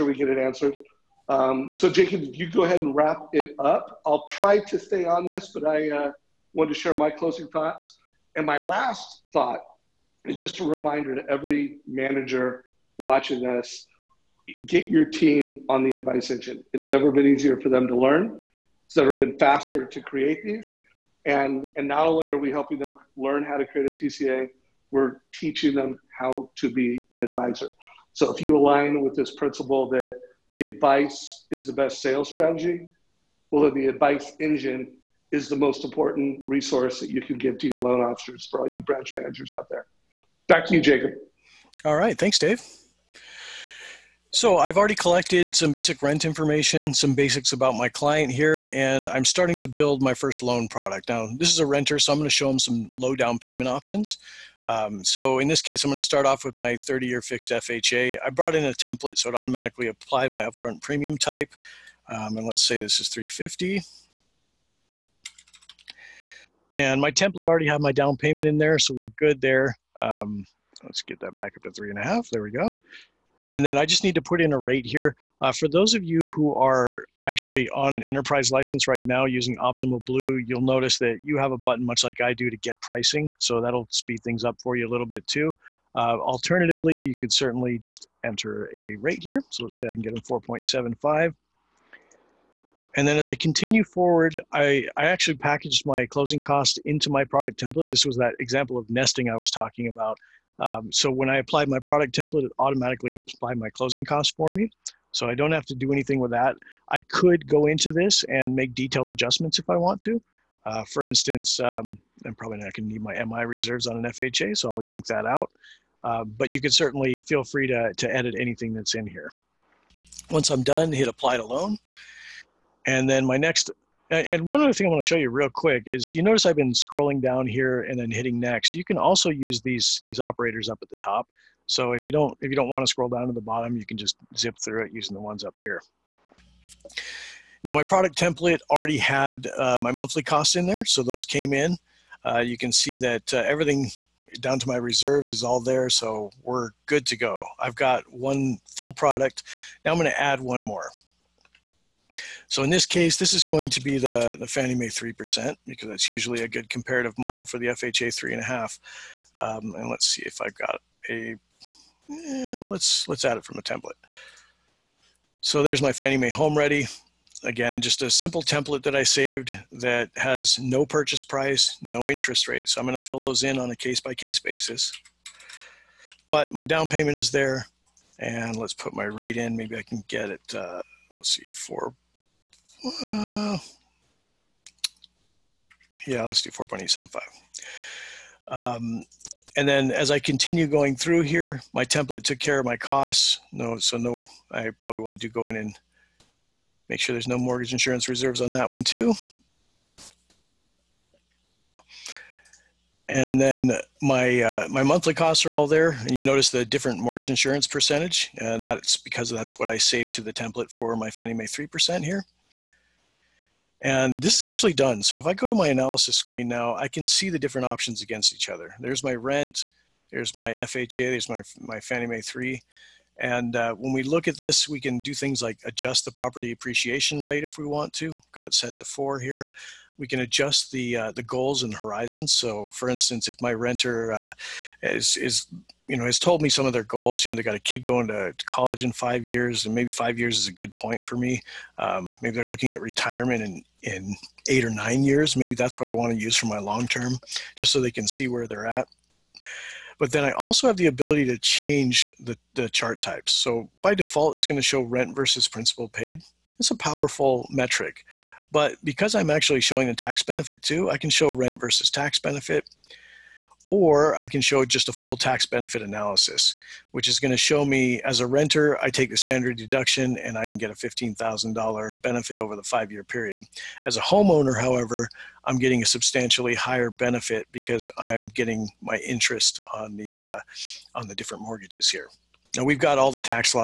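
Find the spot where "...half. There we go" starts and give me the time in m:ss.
1:12.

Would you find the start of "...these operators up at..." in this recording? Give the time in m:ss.
2:10.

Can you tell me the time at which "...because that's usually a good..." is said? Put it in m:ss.
2:35.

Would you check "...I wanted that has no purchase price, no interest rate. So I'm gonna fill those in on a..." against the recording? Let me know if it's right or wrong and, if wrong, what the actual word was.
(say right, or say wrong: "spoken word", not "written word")
wrong: "saved", not "wanted".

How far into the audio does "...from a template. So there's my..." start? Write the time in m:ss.
2:43.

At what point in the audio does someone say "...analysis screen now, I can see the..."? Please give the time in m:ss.
3:35.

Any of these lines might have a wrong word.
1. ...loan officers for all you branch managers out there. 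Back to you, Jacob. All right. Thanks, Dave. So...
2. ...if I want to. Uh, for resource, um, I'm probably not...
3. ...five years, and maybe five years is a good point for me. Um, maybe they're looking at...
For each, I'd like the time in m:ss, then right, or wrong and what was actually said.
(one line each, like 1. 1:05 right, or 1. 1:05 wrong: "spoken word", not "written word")
1. 0:37 right
2. 1:49 wrong: "instance", not "resource"
3. 3:58 right.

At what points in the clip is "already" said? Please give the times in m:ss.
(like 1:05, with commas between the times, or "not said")
0:44, 1:07, 2:18.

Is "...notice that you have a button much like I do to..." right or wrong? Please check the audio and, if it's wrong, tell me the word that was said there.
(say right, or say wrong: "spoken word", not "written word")
right.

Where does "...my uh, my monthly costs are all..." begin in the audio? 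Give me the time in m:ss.
3:24.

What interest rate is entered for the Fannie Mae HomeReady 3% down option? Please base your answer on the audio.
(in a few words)
4.875.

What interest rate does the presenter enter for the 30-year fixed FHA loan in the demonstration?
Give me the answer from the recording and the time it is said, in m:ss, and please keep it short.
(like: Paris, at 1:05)
4.75, at 1:30.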